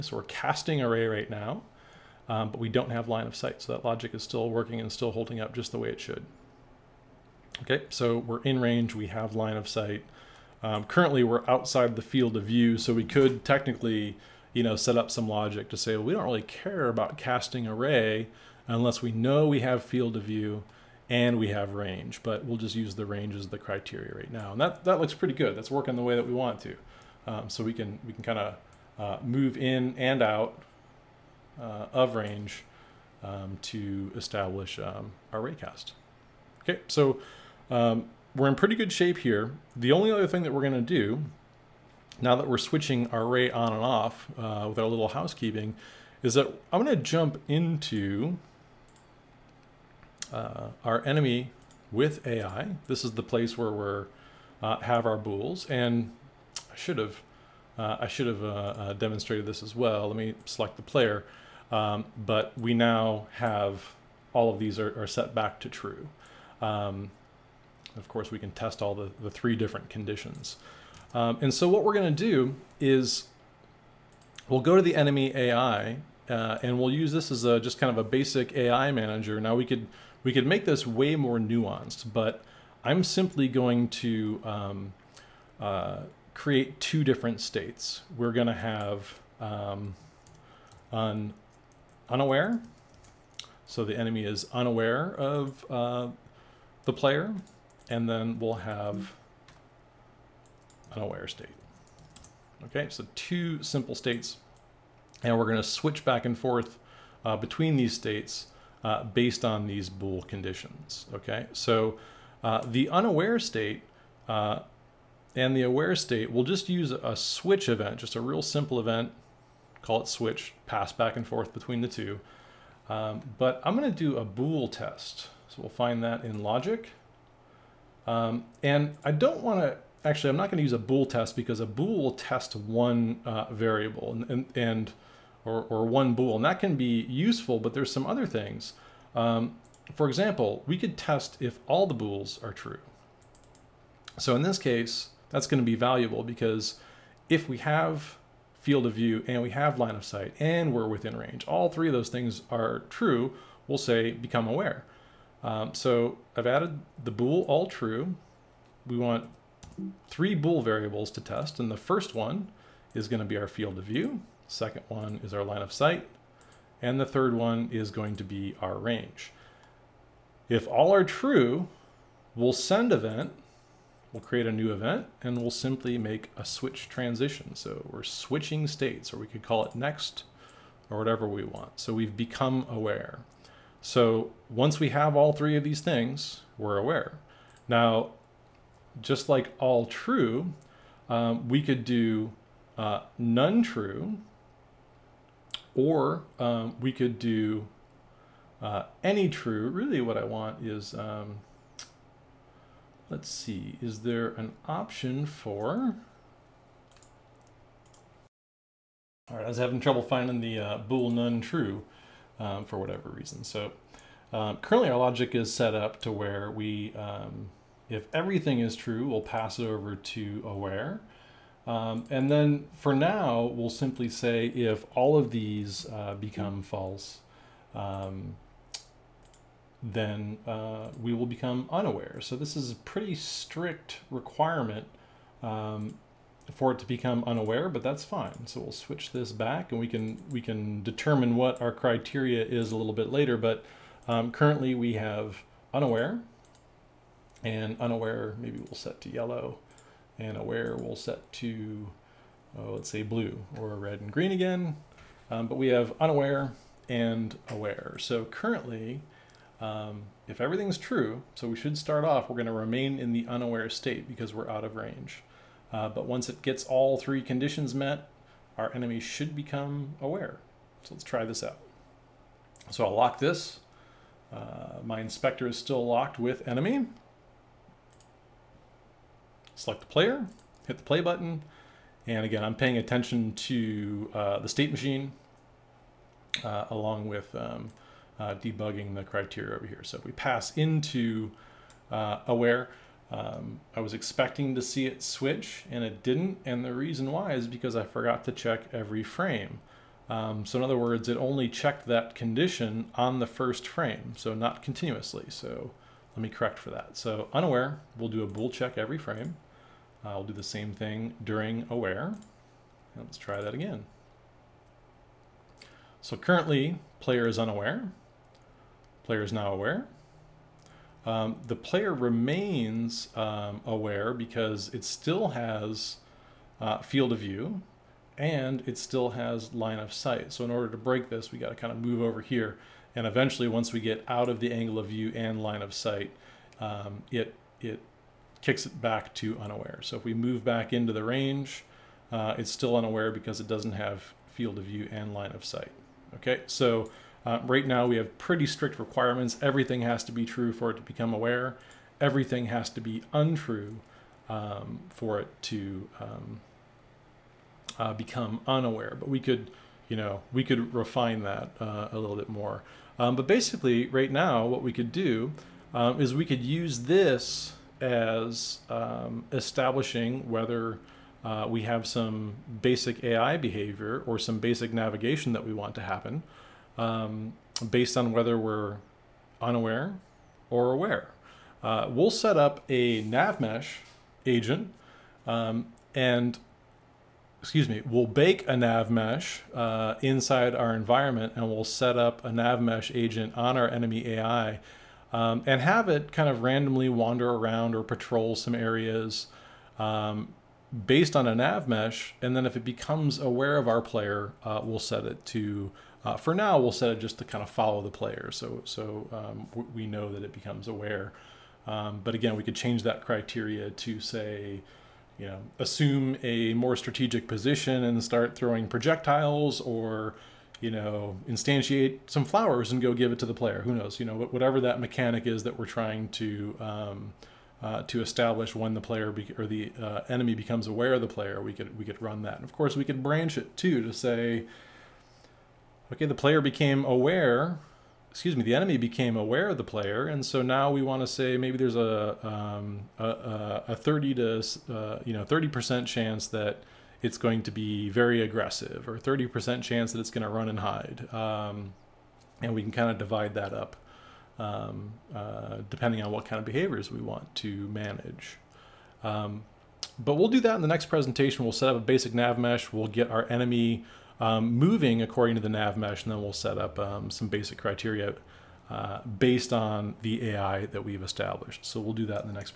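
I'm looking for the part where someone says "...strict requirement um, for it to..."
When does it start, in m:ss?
3:53.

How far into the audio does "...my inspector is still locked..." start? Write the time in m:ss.
4:34.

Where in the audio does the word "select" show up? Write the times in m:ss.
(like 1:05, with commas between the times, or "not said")
1:00, 4:39.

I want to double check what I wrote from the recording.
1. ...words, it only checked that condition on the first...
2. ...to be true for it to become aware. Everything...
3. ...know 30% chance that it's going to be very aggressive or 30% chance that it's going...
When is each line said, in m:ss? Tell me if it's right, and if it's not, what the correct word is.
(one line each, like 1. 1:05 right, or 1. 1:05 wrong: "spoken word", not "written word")
1. 5:00 right
2. 5:50 right
3. 7:25 right.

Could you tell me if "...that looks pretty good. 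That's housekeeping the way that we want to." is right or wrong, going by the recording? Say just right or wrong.
wrong.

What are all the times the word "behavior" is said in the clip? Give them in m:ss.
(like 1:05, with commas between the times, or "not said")
6:13, 7:36.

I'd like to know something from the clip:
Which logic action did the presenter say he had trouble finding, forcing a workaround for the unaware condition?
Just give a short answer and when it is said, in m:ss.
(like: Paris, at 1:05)
bool none true, at 3:30.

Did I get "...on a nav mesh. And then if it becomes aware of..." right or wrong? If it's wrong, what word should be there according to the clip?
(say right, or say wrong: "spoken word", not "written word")
right.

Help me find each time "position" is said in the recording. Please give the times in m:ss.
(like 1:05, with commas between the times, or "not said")
6:57.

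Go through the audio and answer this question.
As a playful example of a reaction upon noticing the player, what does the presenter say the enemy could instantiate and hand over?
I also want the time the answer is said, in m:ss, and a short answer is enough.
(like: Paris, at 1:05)
flowers, at 7:02.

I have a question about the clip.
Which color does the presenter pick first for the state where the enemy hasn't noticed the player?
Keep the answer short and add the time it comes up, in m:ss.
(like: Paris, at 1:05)
yellow, at 4:09.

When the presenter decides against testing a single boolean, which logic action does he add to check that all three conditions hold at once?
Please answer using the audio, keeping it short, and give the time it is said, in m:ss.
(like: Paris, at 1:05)
bool all true, at 2:37.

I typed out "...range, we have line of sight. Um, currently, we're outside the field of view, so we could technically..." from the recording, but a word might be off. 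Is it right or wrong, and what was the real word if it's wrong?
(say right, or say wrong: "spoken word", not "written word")
right.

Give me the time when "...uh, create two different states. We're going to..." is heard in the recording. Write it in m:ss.
1:25.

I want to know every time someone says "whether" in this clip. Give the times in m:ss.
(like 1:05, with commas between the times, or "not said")
6:10, 6:18.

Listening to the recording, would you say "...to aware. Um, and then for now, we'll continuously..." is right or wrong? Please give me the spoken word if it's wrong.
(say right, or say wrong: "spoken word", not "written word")
wrong: "simply", not "continuously".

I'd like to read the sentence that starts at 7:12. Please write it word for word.
And of course, we could branch it too to say, okay, the player became aware.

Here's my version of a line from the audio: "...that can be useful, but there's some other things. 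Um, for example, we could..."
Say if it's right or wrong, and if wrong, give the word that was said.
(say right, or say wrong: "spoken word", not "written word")
right.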